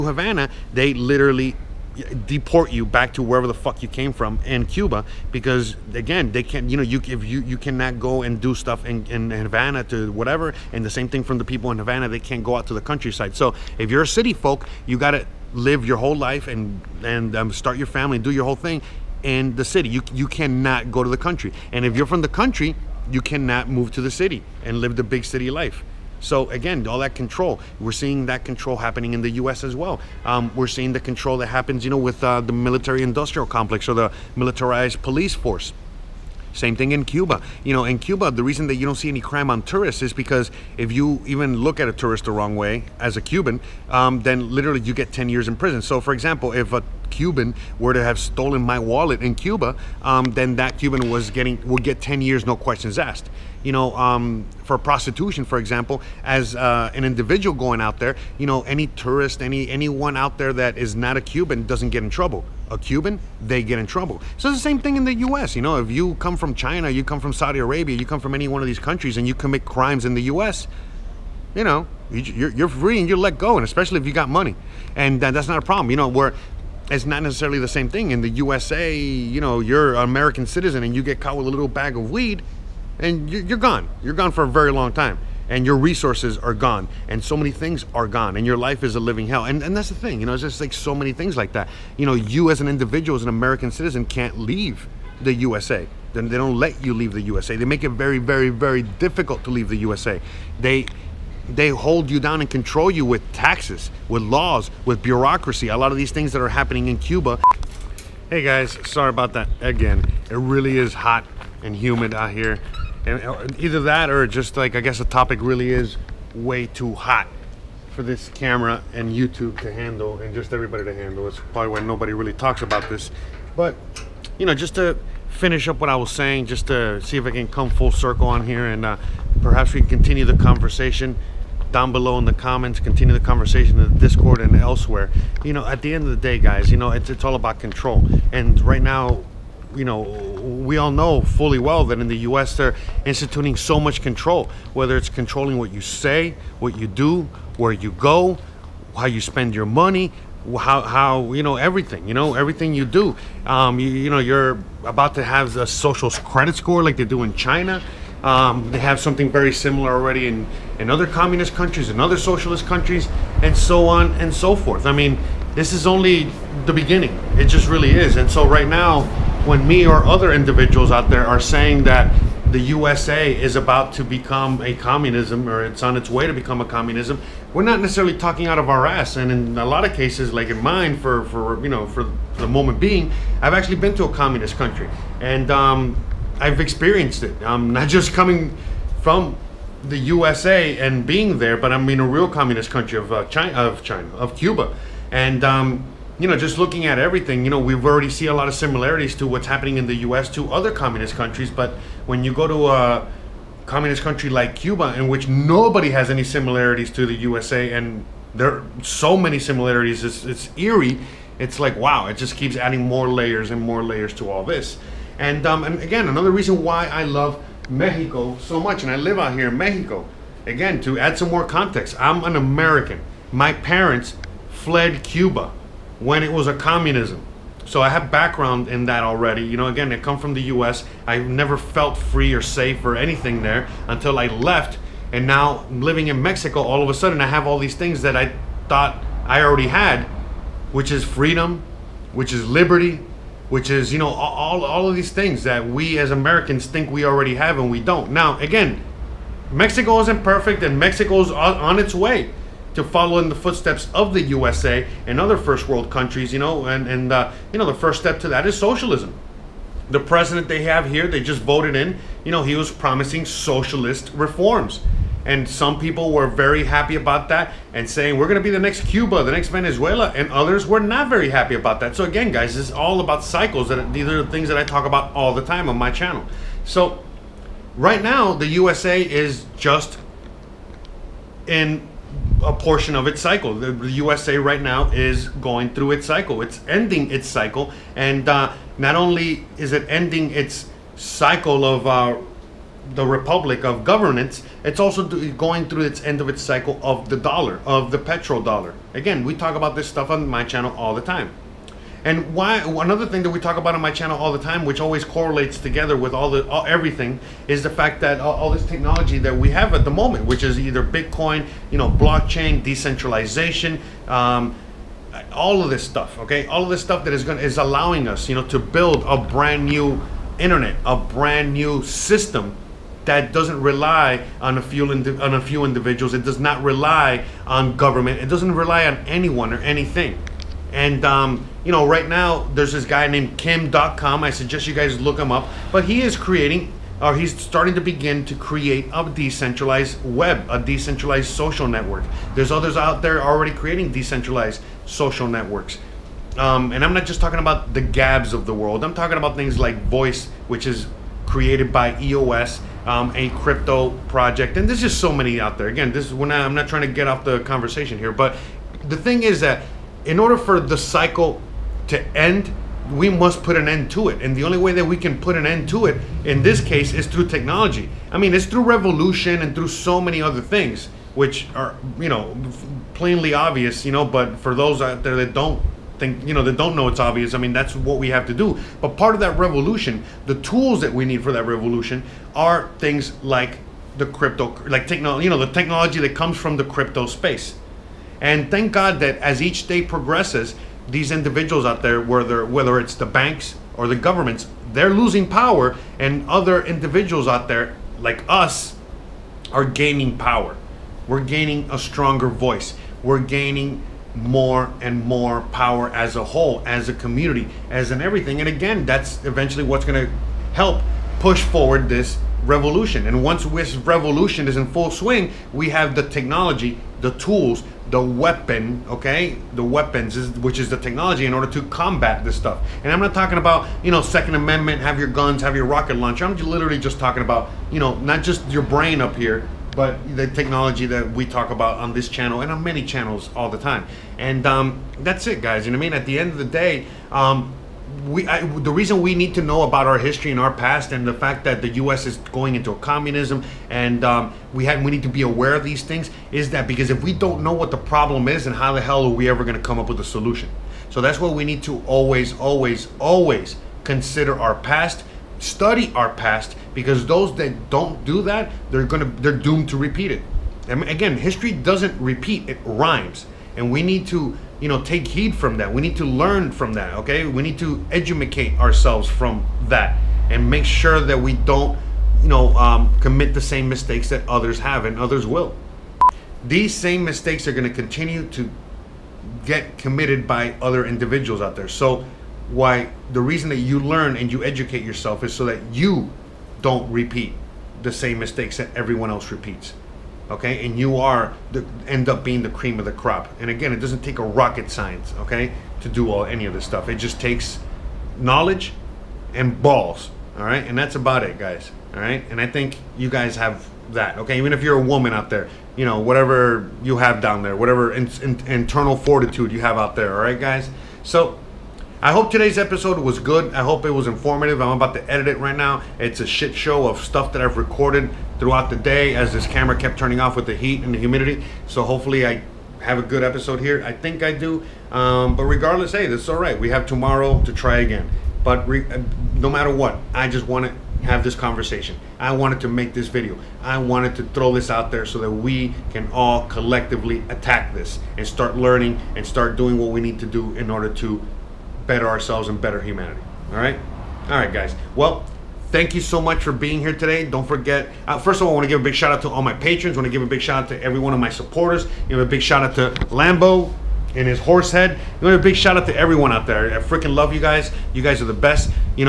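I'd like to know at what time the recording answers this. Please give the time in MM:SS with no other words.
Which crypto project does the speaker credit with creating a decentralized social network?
05:52.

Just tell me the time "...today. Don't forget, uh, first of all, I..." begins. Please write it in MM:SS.
09:06.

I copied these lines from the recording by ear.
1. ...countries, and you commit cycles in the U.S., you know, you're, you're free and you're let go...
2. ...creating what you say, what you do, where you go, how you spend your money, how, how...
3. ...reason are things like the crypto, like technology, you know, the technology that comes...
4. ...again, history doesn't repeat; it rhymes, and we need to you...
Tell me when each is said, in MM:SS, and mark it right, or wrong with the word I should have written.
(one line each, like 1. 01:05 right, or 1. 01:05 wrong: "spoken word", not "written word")
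1. 01:08 wrong: "crimes", not "cycles"
2. 02:25 wrong: "controlling", not "creating"
3. 06:21 wrong: "revolution", not "reason"
4. 07:40 right.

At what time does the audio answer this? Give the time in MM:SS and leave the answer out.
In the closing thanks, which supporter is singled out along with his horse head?
09:13.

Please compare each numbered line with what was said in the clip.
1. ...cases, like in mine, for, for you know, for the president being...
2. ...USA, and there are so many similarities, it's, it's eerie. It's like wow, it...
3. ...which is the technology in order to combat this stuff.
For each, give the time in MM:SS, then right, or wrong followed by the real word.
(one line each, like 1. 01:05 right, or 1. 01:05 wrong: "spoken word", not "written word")
1. 02:59 wrong: "moment", not "president"
2. 03:27 right
3. 07:00 right.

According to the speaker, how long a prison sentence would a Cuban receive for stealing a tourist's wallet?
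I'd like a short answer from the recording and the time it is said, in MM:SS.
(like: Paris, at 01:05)
10 years, at 00:52.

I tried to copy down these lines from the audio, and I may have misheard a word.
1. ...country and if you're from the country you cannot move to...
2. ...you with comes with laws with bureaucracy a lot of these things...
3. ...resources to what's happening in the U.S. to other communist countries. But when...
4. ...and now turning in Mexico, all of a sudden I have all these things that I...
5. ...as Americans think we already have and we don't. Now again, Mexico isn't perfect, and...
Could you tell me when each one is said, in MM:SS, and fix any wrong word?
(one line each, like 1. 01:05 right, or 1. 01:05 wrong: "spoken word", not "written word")
1. 00:21 right
2. 01:42 wrong: "taxes", not "comes"
3. 03:18 wrong: "similarities", not "resources"
4. 03:55 wrong: "living", not "turning"
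5. 04:05 right.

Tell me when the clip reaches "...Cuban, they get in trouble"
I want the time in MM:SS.
01:02.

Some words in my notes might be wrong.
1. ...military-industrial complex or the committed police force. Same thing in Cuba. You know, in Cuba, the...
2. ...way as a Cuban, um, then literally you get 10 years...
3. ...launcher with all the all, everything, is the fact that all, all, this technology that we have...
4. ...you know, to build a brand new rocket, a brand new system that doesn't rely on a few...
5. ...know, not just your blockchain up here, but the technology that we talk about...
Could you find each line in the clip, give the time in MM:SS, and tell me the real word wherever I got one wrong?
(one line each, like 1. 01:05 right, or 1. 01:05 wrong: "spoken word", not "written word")
1. 00:32 wrong: "militarized", not "committed"
2. 00:42 right
3. 05:05 wrong: "together", not "launcher"
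4. 05:18 wrong: "internet", not "rocket"
5. 07:07 wrong: "brain", not "blockchain".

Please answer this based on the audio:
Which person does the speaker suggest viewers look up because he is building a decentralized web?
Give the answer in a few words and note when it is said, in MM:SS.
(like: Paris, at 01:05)
Kim Dotcom, at 05:33.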